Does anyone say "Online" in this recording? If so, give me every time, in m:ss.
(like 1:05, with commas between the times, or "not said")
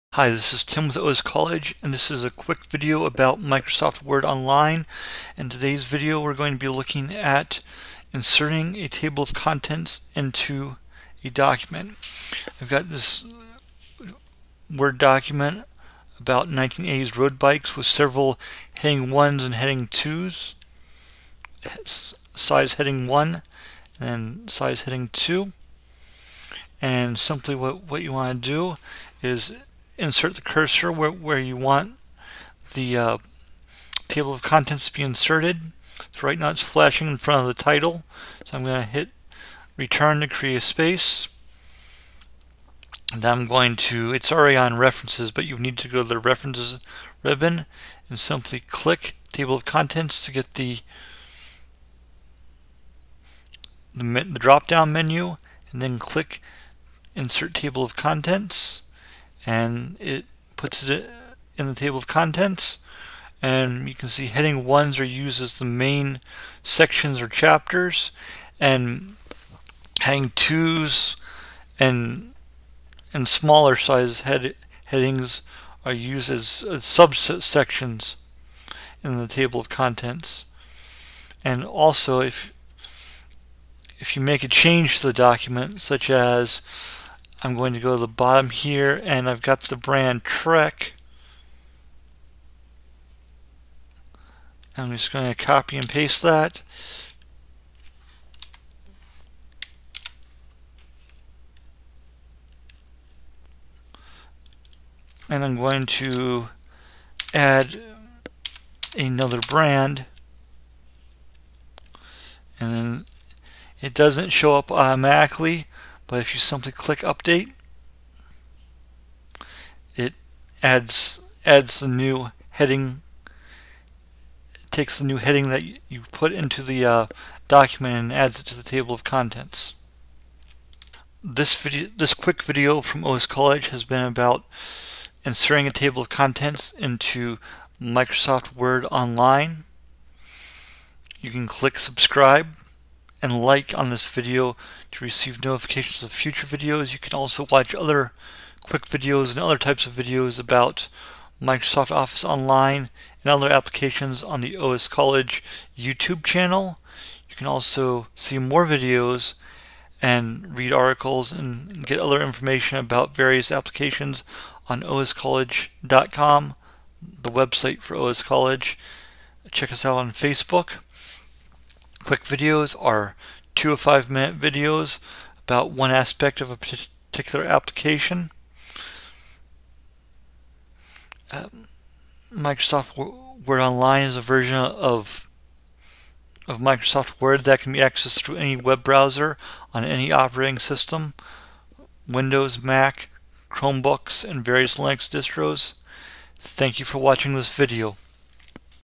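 0:04, 2:18, 2:32, 3:03.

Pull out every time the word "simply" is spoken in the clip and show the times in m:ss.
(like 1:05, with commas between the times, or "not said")
0:27, 0:48, 1:56.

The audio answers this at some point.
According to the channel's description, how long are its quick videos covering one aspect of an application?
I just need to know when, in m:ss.
2:53.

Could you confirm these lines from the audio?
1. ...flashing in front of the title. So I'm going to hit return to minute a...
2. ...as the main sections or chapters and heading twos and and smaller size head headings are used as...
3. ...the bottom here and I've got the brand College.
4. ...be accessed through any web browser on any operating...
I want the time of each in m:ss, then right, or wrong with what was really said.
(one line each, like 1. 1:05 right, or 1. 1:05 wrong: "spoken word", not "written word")
1. 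0:36 wrong: "create", not "minute"
2. 1:05 right
3. 1:28 wrong: "Trek", not "College"
4. 3:07 right.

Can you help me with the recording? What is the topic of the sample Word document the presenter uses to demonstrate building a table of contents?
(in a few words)
1980s road bikes.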